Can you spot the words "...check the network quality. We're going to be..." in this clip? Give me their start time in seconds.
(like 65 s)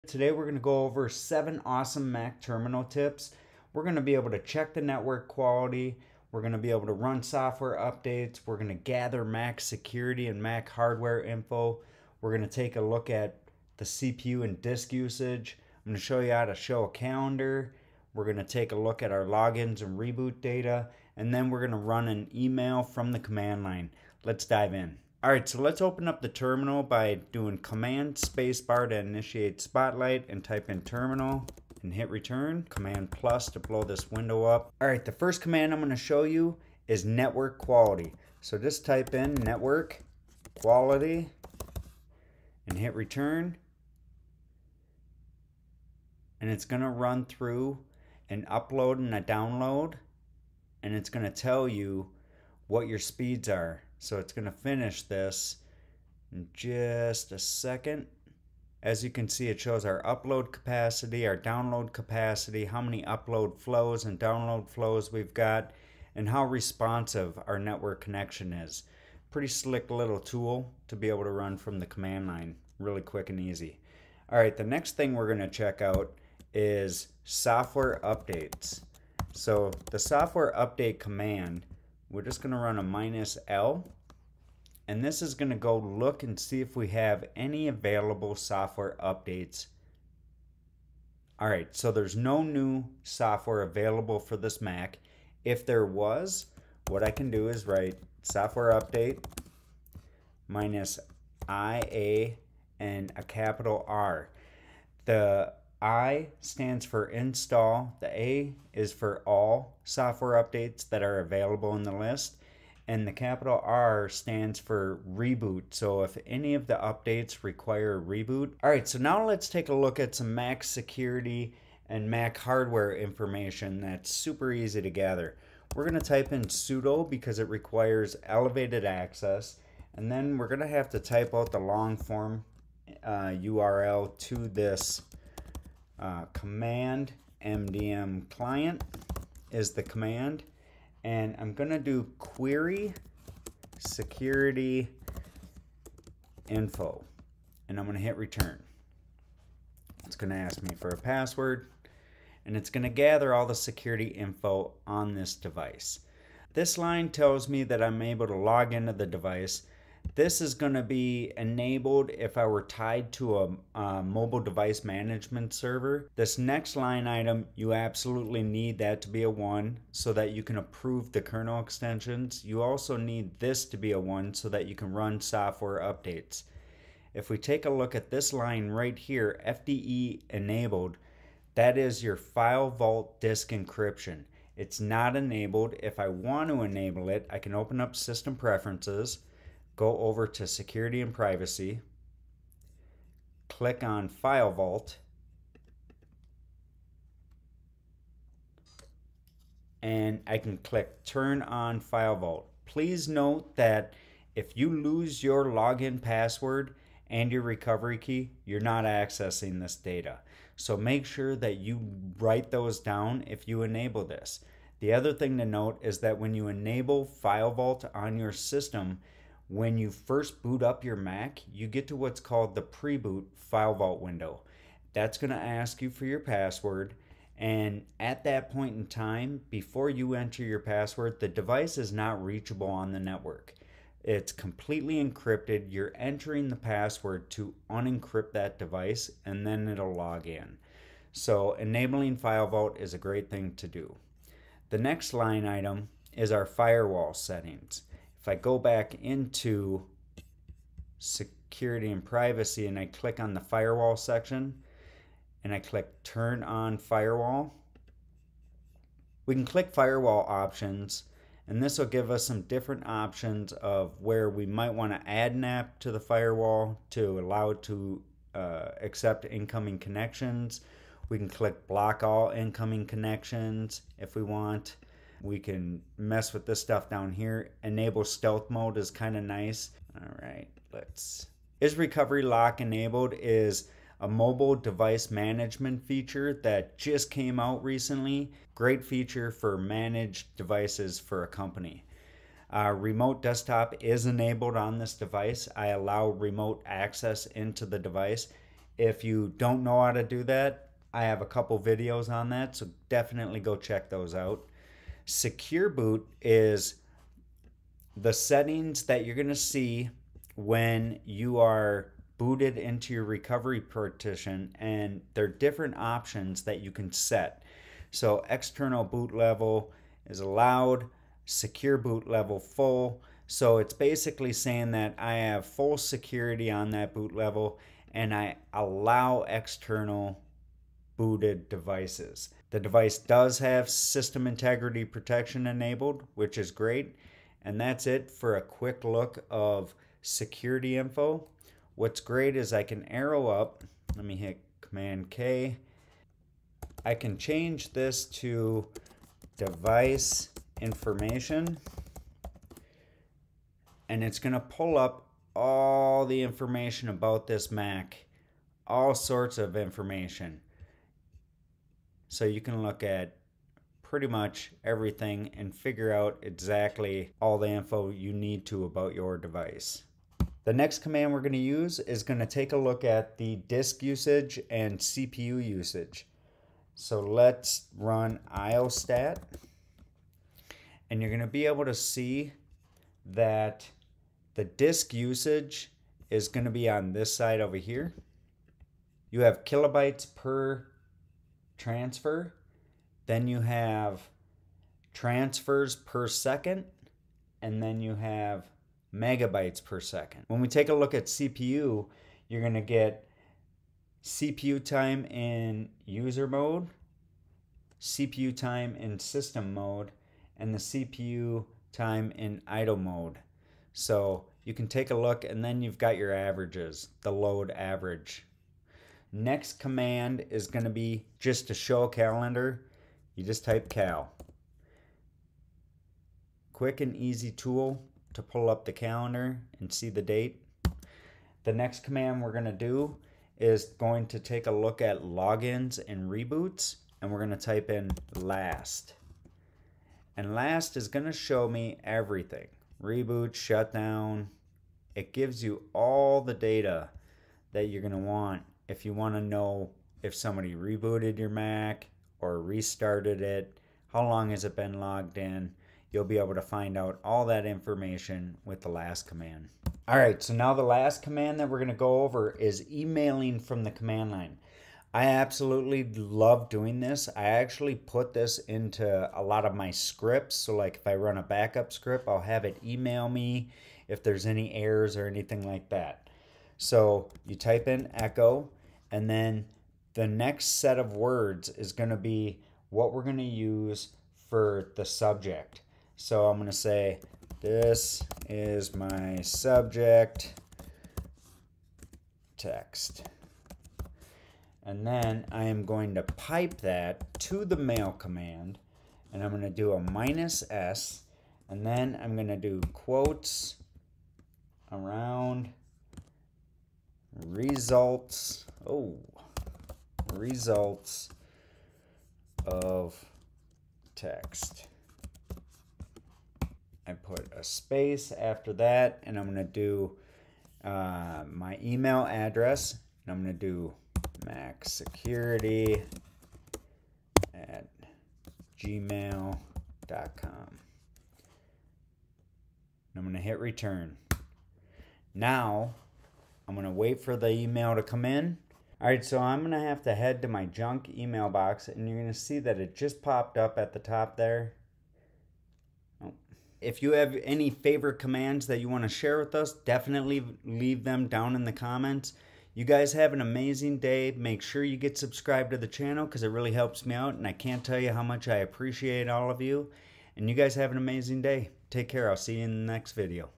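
4 s.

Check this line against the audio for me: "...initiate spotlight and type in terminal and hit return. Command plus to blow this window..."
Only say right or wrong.
right.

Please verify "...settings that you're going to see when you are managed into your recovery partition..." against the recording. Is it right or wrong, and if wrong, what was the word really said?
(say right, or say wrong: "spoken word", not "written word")
wrong: "booted", not "managed".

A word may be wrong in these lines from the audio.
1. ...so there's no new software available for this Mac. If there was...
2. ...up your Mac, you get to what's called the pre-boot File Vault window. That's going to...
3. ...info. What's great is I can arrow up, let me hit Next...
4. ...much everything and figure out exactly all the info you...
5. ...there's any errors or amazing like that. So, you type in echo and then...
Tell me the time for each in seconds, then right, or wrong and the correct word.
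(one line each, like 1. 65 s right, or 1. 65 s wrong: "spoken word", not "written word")
1. 91 s right
2. 220 s right
3. 340 s wrong: "Command", not "Next"
4. 364 s right
5. 474 s wrong: "anything", not "amazing".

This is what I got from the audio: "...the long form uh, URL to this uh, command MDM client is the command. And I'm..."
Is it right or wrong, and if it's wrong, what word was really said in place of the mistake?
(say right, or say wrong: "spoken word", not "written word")
right.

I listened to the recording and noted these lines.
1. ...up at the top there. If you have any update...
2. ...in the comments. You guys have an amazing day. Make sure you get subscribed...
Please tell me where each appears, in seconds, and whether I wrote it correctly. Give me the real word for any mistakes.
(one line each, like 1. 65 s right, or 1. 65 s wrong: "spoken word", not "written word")
1. 543 s wrong: "favorite", not "update"
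2. 551 s right.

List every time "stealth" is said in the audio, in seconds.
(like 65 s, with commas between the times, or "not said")
278 s.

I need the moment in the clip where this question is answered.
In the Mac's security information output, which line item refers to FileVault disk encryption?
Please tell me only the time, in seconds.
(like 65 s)
179 s.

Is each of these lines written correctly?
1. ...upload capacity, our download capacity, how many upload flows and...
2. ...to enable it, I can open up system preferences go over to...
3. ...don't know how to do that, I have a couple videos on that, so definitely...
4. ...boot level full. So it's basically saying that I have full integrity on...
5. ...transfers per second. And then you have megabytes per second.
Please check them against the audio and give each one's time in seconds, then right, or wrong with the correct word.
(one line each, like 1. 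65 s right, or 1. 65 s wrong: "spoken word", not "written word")
1. 60 s right
2. 186 s right
3. 299 s right
4. 321 s wrong: "security", not "integrity"
5. 394 s right.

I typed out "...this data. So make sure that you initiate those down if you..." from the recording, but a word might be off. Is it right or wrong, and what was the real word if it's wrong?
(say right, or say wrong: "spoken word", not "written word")
wrong: "write", not "initiate".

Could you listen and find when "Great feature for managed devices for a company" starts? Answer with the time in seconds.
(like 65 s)
288 s.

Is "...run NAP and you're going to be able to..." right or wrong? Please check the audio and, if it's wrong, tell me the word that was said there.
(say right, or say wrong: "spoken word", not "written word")
wrong: "IOSTAT", not "NAP".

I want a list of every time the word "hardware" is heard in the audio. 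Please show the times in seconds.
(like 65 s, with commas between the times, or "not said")
10 s, 122 s.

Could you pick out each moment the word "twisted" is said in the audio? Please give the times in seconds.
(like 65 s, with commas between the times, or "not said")
not said.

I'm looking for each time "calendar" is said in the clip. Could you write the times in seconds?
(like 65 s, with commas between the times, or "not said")
16 s, 421 s, 428 s.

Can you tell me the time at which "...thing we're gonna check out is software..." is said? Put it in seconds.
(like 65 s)
74 s.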